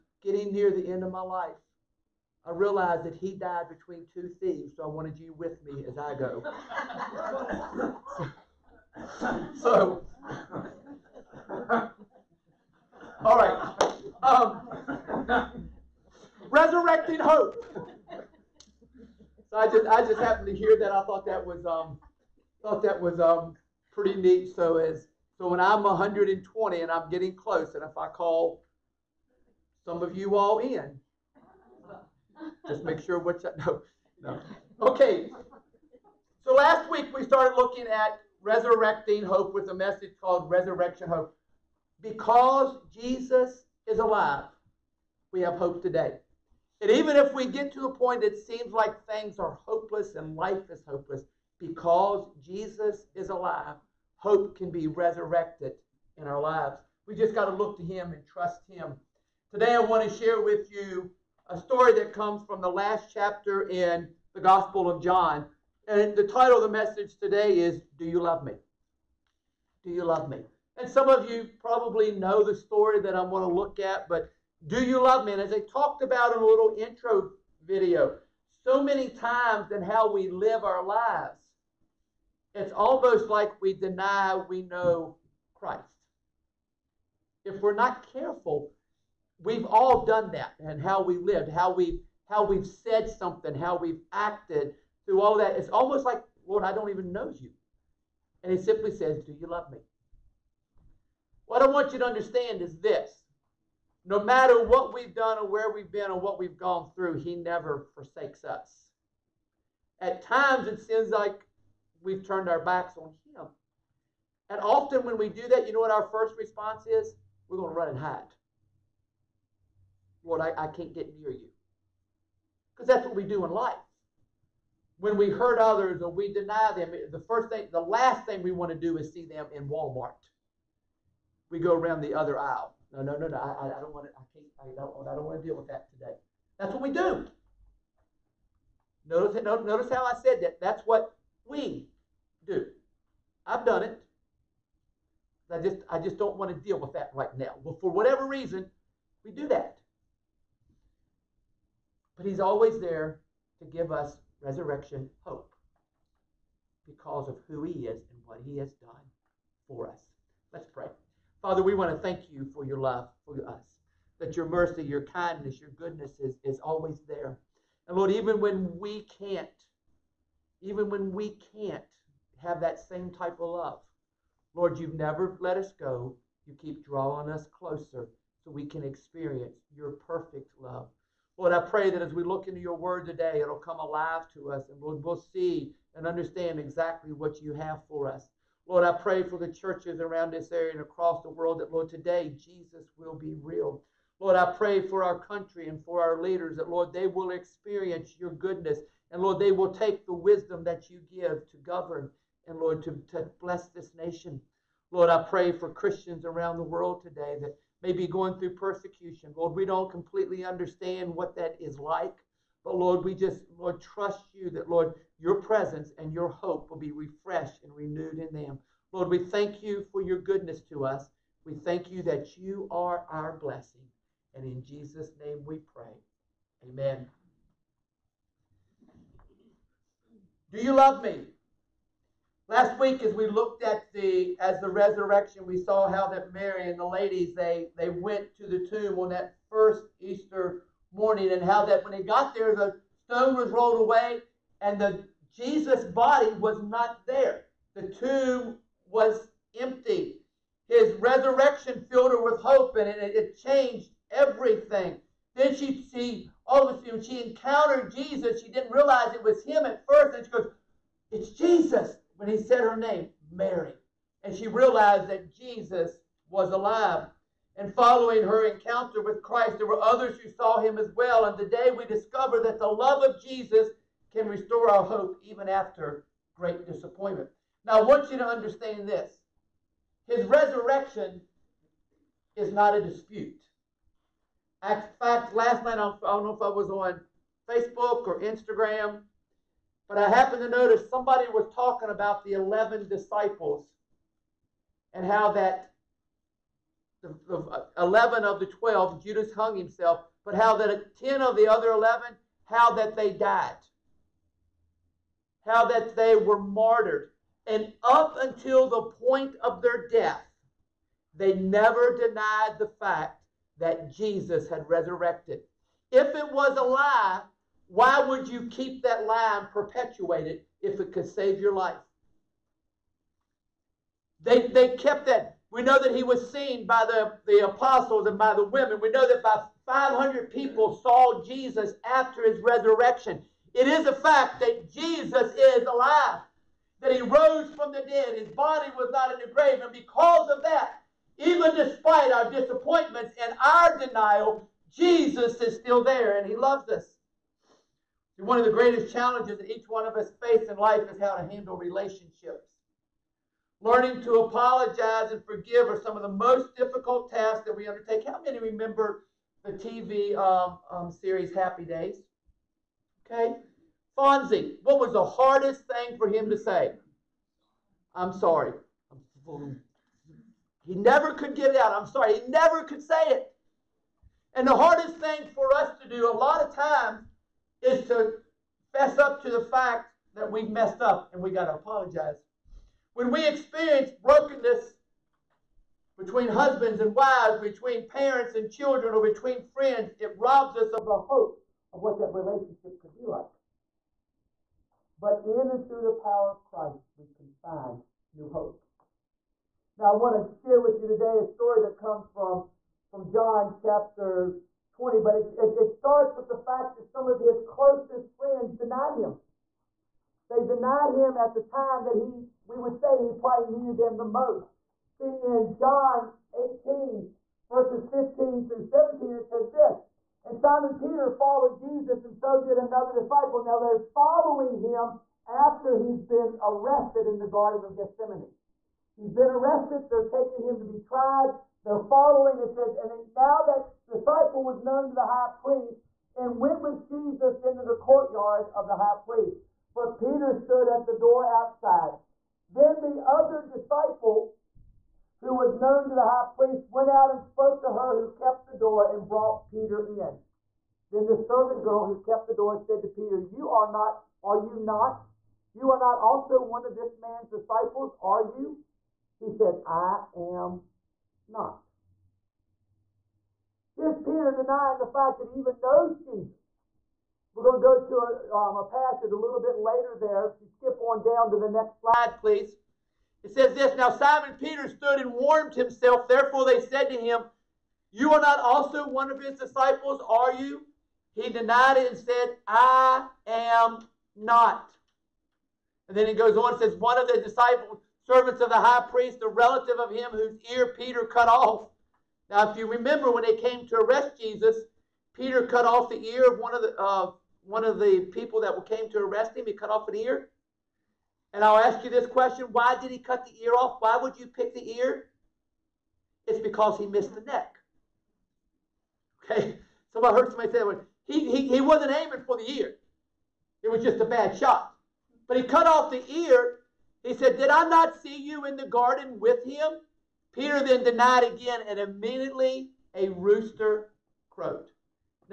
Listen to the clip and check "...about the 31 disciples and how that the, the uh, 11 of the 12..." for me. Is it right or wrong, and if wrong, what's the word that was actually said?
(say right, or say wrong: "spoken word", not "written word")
wrong: "11", not "31".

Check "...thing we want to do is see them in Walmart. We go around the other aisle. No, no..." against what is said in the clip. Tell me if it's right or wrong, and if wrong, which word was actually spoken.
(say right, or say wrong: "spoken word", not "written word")
right.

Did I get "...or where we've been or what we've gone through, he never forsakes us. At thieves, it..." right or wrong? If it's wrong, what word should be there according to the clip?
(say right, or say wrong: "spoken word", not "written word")
wrong: "times", not "thieves".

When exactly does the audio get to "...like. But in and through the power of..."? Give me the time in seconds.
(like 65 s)
393 s.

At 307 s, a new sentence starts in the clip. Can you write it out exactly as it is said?
And up until the point of their death, they never denied the fact that Jesus had resurrected.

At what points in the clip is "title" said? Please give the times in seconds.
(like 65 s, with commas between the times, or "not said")
66 s.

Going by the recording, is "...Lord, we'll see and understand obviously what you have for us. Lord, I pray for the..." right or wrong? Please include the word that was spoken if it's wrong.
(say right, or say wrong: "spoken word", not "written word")
wrong: "exactly", not "obviously".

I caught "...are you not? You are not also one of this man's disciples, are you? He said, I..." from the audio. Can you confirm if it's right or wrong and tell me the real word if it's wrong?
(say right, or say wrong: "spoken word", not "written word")
right.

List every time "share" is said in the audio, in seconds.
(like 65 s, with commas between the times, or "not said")
60 s, 400 s.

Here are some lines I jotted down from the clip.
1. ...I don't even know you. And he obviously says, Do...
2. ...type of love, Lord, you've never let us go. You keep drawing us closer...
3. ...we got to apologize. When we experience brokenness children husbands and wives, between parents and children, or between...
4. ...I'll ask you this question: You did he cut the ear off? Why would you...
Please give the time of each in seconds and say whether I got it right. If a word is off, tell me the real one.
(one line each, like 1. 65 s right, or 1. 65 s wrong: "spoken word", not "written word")
1. 96 s wrong: "simply", not "obviously"
2. 173 s right
3. 381 s wrong: "between", not "children"
4. 501 s wrong: "Why", not "You".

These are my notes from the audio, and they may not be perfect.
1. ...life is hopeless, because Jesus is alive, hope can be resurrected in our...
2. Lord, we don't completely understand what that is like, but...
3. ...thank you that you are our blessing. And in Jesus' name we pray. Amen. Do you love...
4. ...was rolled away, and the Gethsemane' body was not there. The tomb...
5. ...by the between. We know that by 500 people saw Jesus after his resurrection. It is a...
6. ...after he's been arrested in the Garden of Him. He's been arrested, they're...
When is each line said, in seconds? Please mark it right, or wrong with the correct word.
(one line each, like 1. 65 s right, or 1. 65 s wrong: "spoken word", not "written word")
1. 50 s right
2. 209 s right
3. 221 s right
4. 243 s wrong: "Jesus", not "Gethsemane"
5. 328 s wrong: "women", not "between"
6. 425 s wrong: "Gethsemane", not "Him".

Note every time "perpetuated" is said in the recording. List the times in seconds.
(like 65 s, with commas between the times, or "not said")
319 s.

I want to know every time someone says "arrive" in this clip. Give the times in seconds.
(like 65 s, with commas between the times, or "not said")
not said.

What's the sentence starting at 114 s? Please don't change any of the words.
And often, when we do that, you know what our first response is?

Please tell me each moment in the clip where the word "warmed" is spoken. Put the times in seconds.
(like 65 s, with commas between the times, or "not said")
475 s.